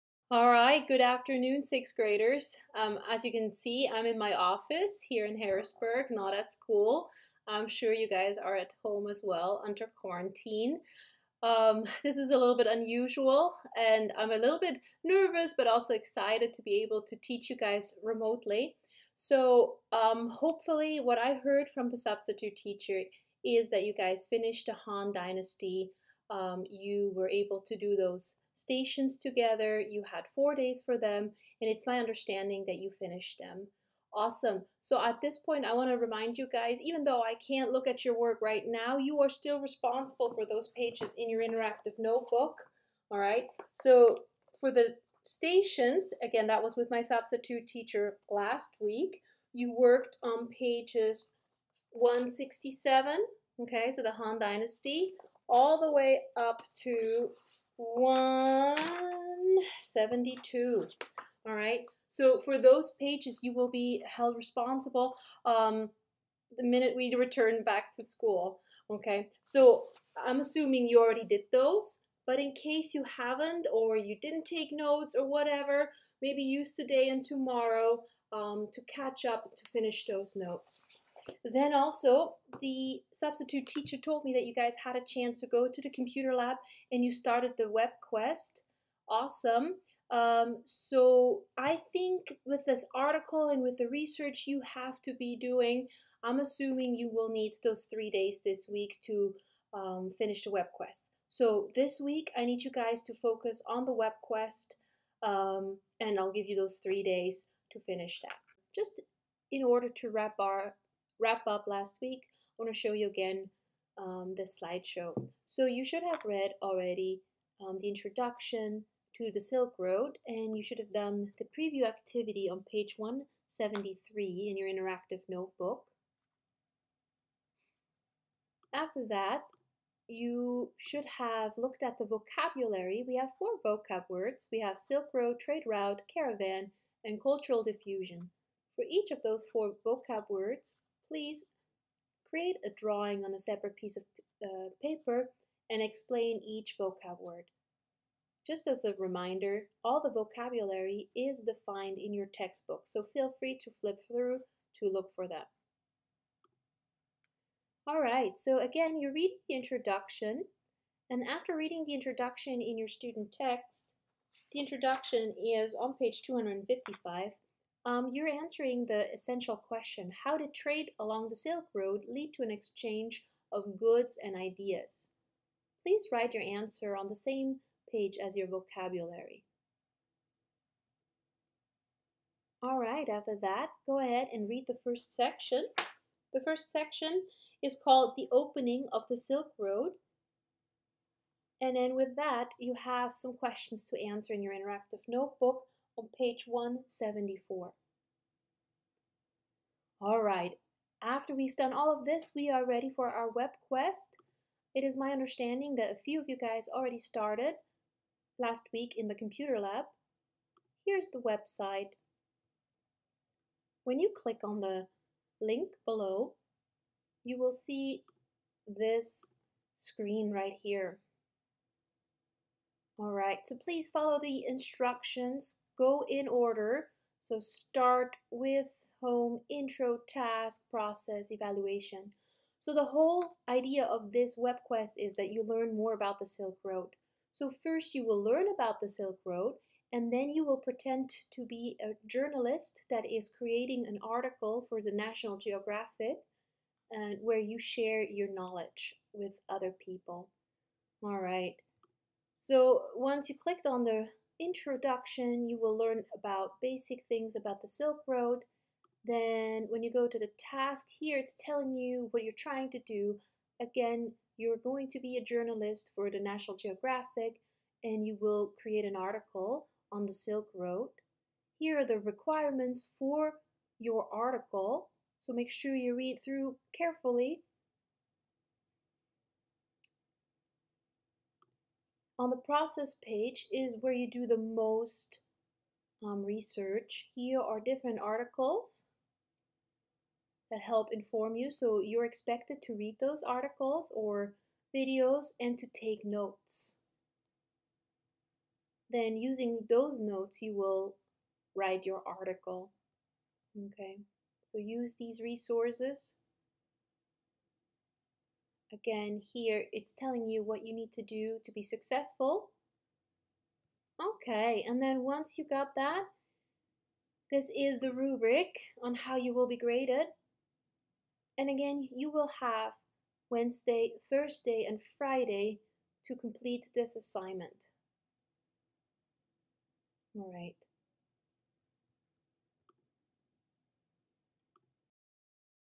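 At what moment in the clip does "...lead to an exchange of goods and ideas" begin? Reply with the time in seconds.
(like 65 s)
172 s.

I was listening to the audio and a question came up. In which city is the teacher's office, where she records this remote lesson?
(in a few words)
Harrisburg.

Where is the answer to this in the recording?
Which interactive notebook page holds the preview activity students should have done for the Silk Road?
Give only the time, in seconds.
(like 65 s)
122 s.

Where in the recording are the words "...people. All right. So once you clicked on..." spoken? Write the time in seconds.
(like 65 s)
249 s.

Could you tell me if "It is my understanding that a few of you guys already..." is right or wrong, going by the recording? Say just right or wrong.
right.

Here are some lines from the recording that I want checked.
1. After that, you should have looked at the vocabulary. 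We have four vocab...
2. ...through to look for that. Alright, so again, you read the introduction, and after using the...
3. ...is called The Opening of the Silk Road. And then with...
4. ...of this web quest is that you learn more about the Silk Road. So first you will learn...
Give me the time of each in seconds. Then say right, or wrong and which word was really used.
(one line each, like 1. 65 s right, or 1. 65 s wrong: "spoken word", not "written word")
1. 128 s right
2. 154 s wrong: "reading", not "using"
3. 187 s right
4. 233 s right.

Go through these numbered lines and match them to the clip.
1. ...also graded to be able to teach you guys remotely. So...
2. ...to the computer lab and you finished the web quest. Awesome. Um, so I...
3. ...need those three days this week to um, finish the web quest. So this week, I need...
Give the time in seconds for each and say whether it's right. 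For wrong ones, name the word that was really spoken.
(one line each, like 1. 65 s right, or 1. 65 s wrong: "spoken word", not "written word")
1. 15 s wrong: "excited", not "graded"
2. 85 s wrong: "started", not "finished"
3. 97 s right.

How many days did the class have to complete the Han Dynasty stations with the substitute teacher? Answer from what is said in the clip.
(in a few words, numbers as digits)
4.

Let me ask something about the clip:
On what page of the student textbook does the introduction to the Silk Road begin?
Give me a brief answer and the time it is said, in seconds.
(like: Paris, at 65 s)
255, at 165 s.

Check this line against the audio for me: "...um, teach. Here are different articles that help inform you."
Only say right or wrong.
wrong.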